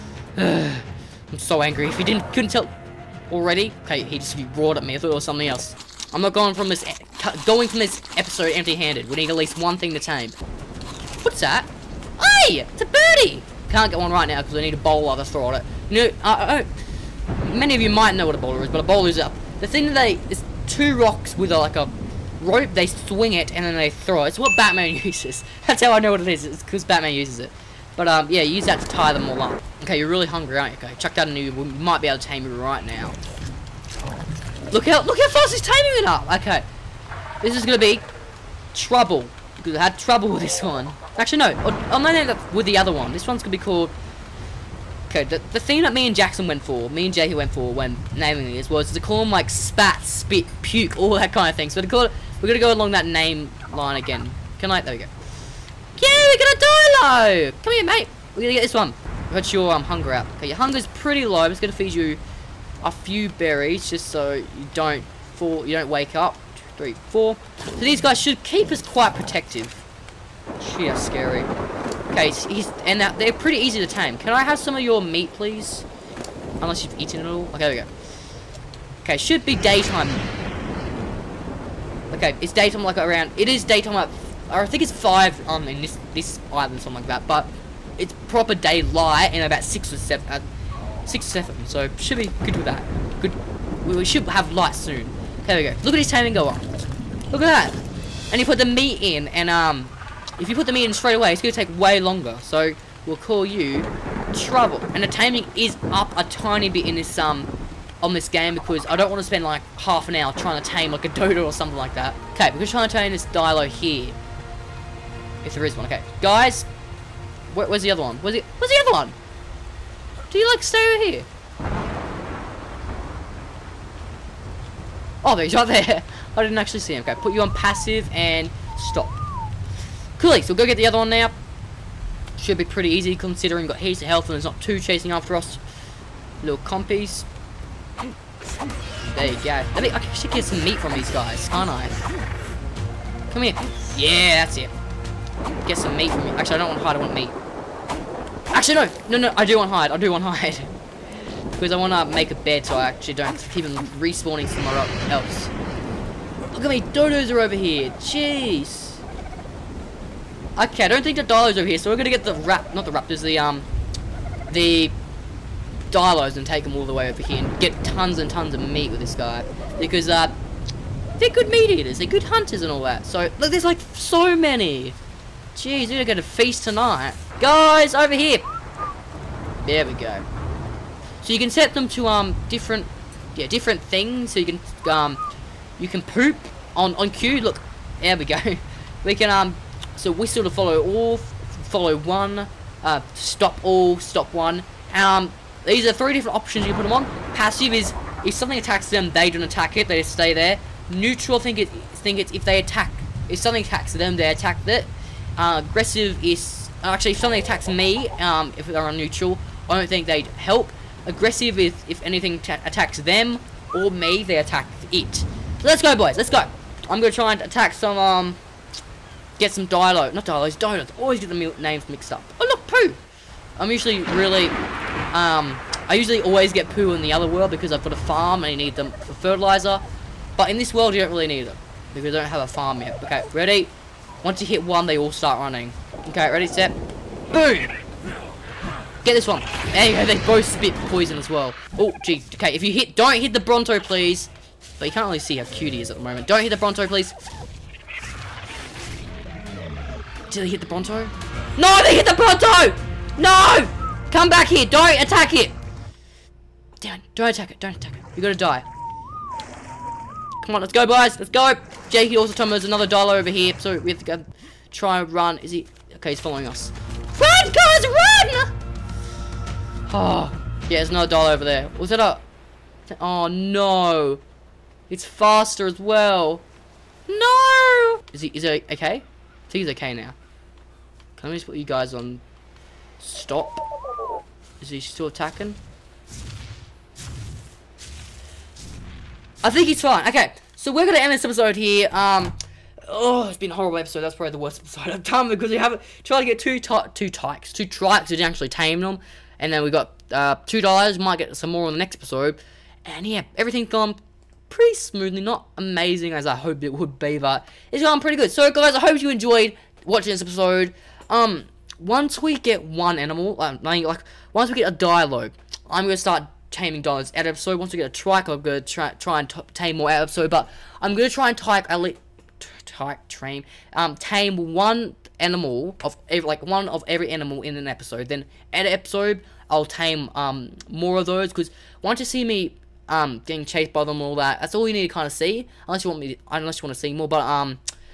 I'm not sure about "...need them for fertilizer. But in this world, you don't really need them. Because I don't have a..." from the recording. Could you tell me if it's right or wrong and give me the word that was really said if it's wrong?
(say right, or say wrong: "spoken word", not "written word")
right.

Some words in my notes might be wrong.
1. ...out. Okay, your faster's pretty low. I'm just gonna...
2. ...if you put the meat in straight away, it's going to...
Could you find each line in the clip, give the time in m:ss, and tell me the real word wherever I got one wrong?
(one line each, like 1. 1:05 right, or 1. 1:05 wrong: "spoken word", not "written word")
1. 1:00 wrong: "hunger", not "faster"
2. 1:40 right.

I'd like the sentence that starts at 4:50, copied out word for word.
Okay, so we're gonna end this episode here.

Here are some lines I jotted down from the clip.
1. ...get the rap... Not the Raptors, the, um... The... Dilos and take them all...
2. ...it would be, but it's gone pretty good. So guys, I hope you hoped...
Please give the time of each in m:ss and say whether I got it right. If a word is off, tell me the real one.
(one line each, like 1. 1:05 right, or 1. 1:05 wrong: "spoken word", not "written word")
1. 2:42 right
2. 5:06 wrong: "enjoyed", not "hoped".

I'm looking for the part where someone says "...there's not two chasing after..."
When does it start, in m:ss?
2:14.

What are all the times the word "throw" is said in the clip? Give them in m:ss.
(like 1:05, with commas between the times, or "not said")
0:15, 0:23.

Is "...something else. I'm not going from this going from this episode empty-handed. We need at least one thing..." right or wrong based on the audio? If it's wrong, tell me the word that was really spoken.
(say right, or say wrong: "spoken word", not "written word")
right.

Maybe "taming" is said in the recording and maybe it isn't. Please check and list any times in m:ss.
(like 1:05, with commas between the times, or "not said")
0:35, 1:36, 1:45, 5:16.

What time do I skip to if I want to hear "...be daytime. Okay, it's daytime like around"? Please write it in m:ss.
1:19.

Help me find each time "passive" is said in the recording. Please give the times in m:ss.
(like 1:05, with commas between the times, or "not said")
2:07, 3:17.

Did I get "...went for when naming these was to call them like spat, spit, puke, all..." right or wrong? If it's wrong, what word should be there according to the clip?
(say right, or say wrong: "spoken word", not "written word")
right.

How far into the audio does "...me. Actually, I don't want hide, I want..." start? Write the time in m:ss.
2:26.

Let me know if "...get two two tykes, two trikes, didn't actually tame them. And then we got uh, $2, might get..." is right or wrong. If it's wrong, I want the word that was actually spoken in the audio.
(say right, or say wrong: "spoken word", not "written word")
right.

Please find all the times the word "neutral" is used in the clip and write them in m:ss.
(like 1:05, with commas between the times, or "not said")
3:20, 3:28.